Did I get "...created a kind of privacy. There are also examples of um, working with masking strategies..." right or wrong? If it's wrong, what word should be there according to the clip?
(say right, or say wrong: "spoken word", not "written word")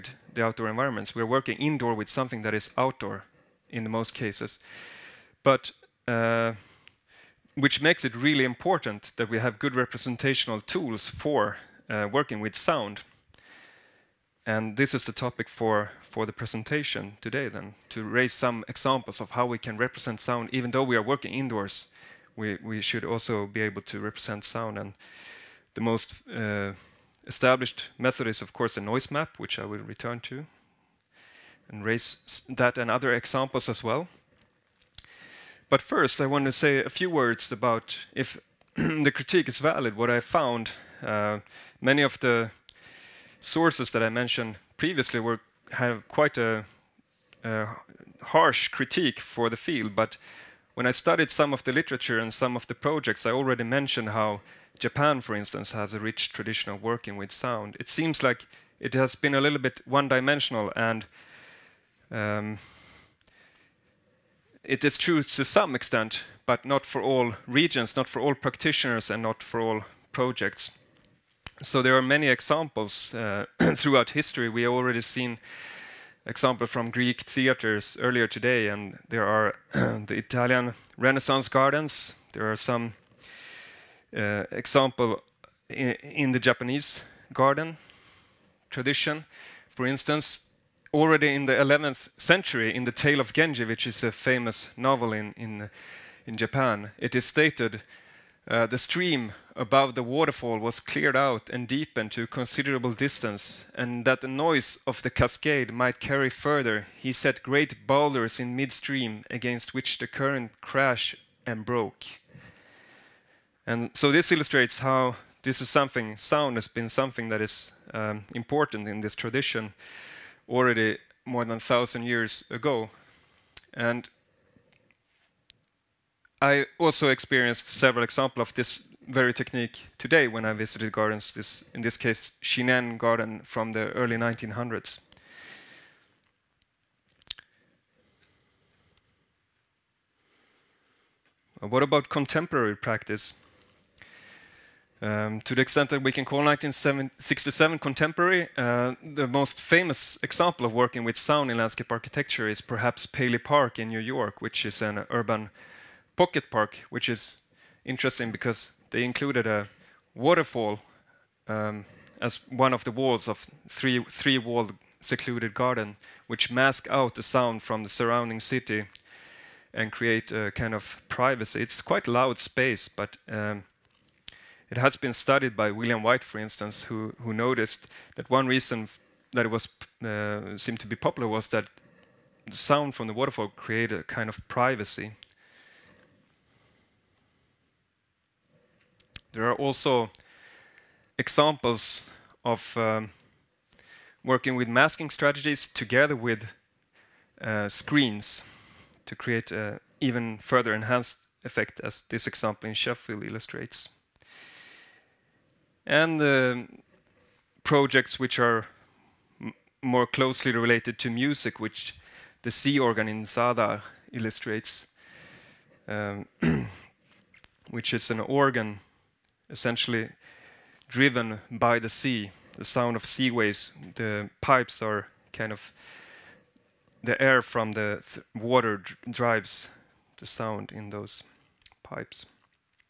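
right.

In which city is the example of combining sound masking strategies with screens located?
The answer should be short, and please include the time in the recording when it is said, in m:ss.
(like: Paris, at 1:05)
Sheffield, at 3:22.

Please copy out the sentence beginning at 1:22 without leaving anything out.
There are some uh, example in, in the Japanese garden tradition.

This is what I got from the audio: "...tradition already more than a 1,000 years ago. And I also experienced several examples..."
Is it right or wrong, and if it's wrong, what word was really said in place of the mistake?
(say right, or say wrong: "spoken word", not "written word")
right.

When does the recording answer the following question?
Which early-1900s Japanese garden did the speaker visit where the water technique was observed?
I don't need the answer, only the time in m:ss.
2:12.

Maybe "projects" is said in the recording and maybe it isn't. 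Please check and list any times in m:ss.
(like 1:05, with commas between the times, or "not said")
0:52, 1:10, 3:27.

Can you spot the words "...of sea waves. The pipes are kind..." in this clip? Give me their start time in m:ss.
3:42.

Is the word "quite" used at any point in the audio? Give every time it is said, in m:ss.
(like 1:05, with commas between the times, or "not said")
0:46, 2:51.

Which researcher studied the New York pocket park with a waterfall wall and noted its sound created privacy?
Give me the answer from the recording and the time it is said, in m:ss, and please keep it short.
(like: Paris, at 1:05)
William Whyte, at 2:55.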